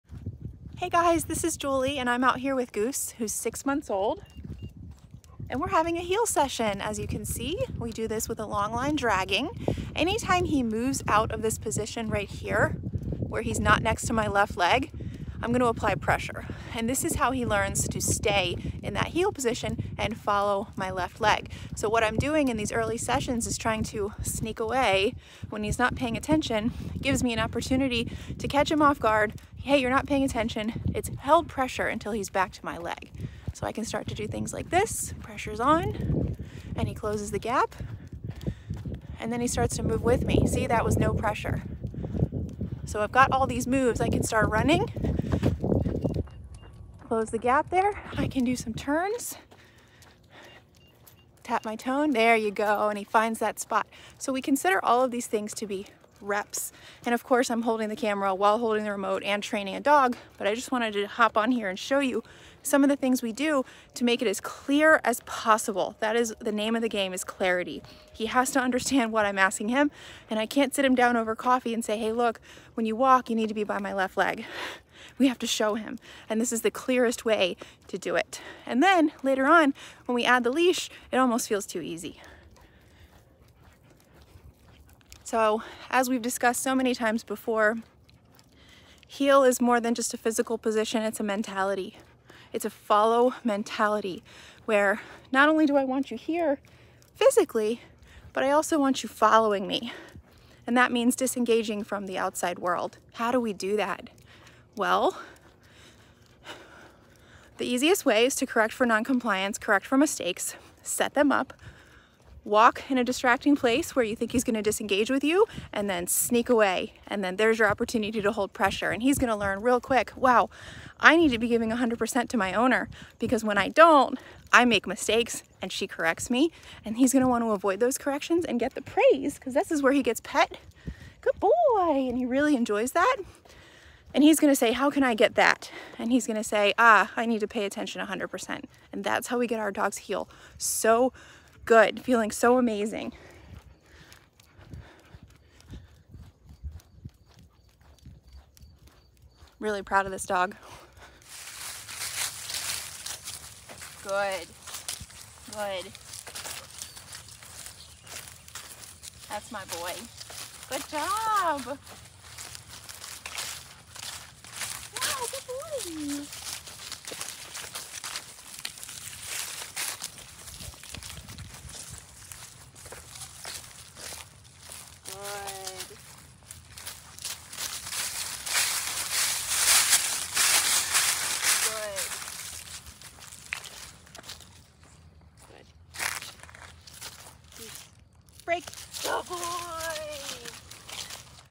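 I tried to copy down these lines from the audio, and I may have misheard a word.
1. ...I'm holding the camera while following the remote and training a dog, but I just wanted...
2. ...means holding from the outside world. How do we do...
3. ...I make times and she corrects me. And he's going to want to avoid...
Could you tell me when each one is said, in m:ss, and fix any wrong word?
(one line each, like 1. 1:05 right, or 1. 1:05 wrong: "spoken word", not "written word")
1. 0:57 wrong: "holding", not "following"
2. 1:40 wrong: "disengaging", not "holding"
3. 2:04 wrong: "mistakes", not "times".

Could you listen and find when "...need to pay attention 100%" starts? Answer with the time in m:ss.
2:17.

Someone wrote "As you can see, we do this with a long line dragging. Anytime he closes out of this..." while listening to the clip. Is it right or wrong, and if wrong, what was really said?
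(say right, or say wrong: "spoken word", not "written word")
wrong: "moves", not "closes".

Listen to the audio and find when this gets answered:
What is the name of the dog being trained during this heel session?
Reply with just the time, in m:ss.
0:02.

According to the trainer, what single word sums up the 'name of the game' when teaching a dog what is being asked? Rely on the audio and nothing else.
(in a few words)
clarity.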